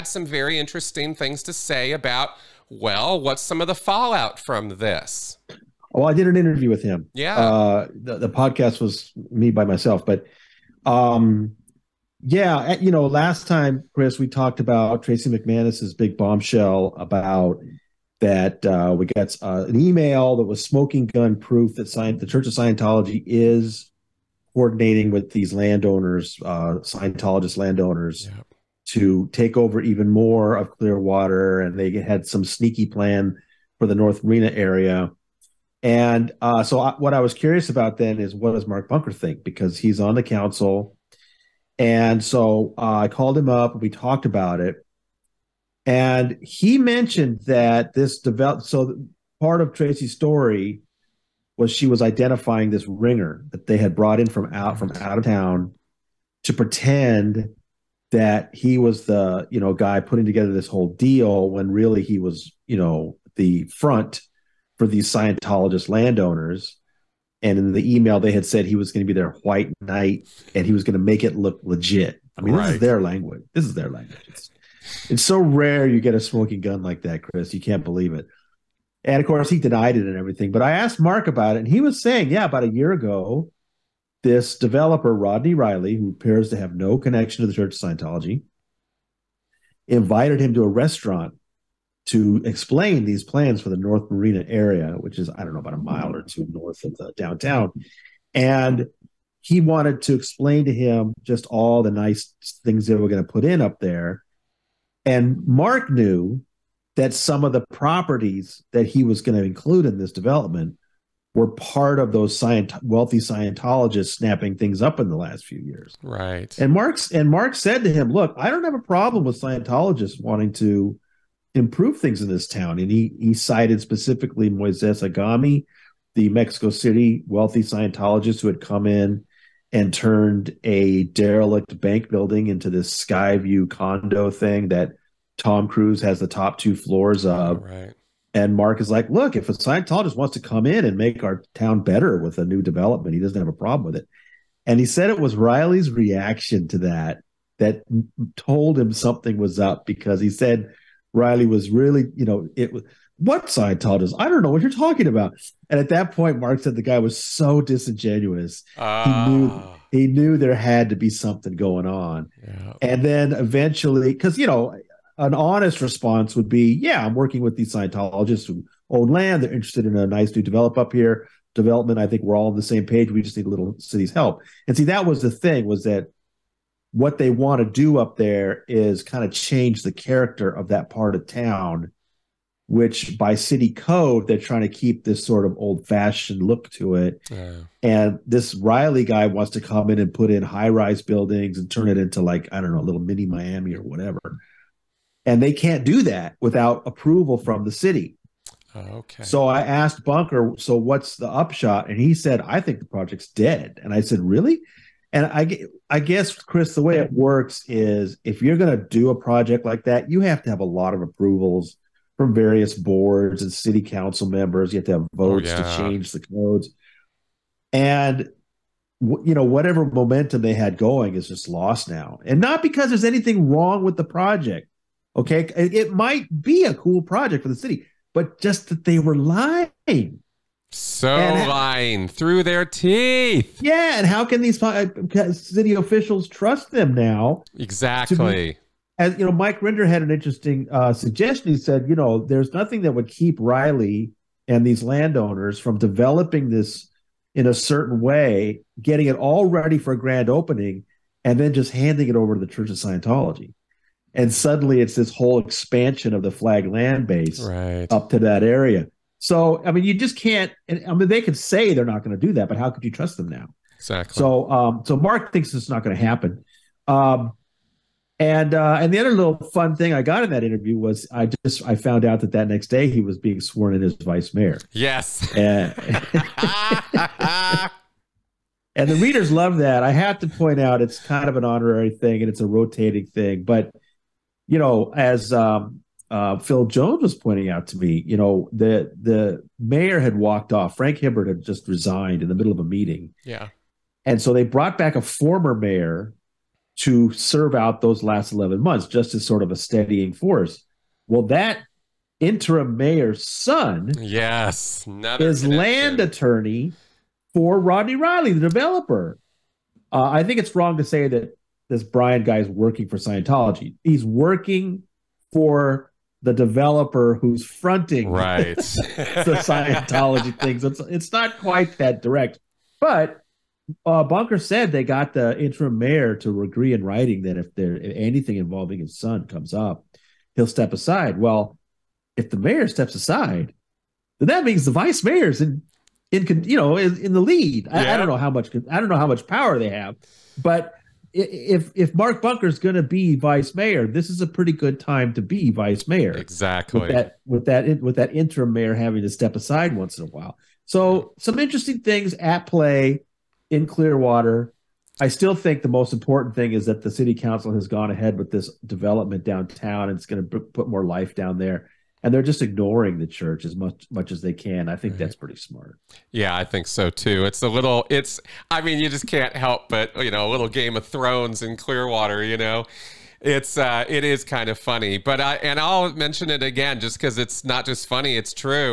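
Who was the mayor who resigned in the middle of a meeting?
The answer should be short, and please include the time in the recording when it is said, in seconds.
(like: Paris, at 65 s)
Frank Hibbard, at 290 s.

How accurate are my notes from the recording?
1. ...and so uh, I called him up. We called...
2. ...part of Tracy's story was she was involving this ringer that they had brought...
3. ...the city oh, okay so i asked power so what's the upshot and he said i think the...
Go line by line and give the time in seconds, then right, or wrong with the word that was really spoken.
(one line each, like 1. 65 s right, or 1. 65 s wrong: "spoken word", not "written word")
1. 41 s wrong: "talked", not "called"
2. 49 s wrong: "identifying", not "involving"
3. 197 s wrong: "bunker", not "power".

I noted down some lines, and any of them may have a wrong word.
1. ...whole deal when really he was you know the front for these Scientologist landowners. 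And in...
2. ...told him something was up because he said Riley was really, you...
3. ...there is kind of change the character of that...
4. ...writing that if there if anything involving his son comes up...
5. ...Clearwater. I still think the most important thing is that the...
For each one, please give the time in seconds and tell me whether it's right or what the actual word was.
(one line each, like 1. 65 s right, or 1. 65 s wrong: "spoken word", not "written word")
1. 60 s right
2. 148 s right
3. 178 s right
4. 326 s right
5. 353 s right.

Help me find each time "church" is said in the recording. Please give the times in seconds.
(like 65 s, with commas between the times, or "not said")
22 s, 87 s, 252 s, 363 s.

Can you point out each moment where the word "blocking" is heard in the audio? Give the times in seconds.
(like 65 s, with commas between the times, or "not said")
not said.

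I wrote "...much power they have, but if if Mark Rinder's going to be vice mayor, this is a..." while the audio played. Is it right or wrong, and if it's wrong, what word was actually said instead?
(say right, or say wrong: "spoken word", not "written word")
wrong: "Bunker", not "Rinder".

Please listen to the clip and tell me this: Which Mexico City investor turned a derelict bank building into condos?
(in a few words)
Moises Agami.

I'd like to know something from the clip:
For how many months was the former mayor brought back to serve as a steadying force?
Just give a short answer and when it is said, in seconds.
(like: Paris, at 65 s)
11, at 298 s.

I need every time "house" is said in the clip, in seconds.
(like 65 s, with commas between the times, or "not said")
not said.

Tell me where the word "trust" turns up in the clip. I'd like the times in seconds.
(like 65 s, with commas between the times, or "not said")
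236 s, 262 s.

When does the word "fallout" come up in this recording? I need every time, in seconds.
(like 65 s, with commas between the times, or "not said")
3 s.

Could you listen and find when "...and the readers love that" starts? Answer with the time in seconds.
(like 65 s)
278 s.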